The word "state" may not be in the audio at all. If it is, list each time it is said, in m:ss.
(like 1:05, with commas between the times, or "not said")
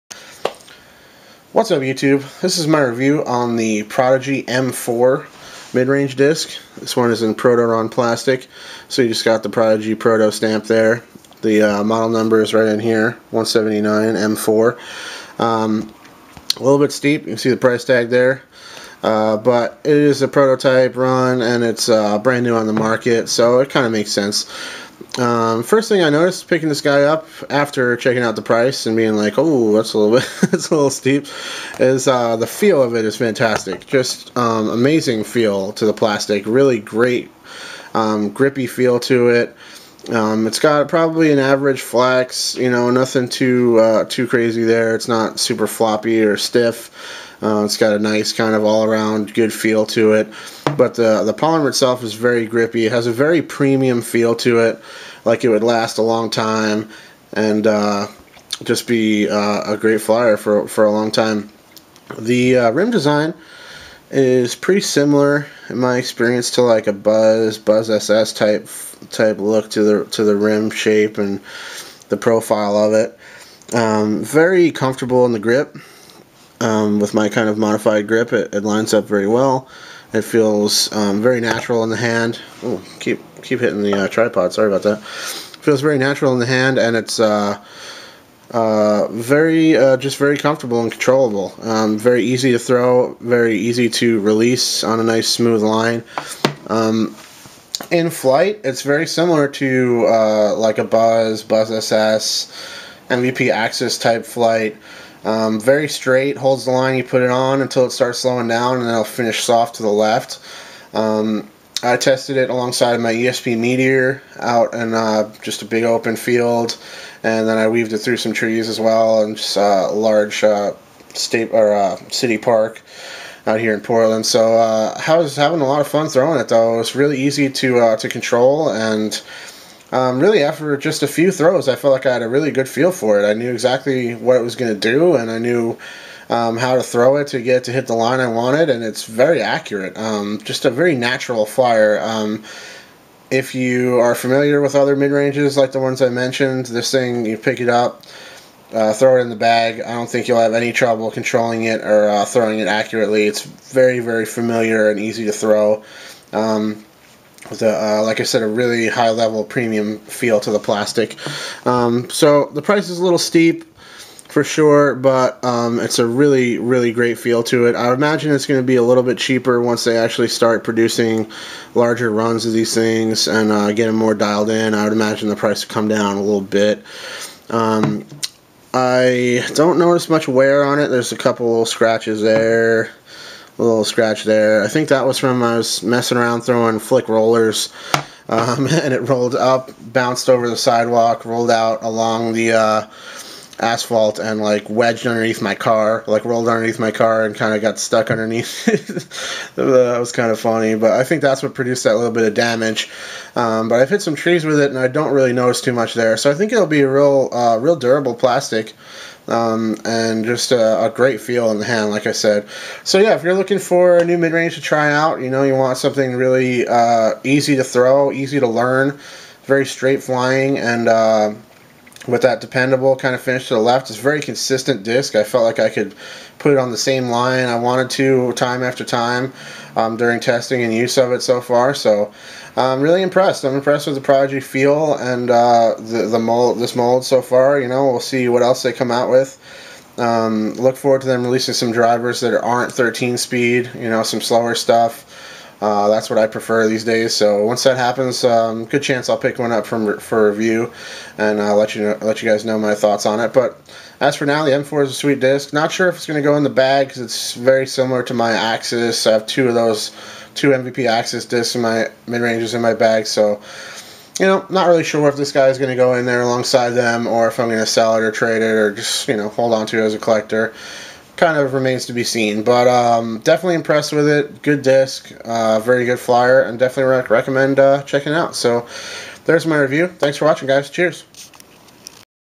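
2:01.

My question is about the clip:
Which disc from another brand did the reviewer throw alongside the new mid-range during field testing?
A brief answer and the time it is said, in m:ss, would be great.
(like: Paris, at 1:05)
ESP Meteor, at 1:53.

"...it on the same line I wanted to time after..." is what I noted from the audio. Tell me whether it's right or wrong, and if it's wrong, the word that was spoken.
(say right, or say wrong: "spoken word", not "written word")
right.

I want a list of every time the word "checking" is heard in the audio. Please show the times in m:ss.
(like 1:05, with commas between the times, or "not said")
0:27, 4:37.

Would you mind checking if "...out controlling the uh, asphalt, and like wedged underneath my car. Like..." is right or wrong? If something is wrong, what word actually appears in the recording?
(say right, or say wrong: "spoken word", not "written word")
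wrong: "along", not "controlling".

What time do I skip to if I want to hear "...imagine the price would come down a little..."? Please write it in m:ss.
2:54.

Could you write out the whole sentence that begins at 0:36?
Really great um, grippy feel to it.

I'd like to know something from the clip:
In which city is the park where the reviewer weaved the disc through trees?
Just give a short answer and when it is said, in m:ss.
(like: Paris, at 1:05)
Portland, at 2:03.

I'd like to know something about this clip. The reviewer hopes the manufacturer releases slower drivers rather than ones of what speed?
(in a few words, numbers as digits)
13.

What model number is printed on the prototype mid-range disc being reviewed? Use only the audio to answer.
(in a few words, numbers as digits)
179 M4.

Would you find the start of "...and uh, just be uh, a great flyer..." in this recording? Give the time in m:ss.
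0:57.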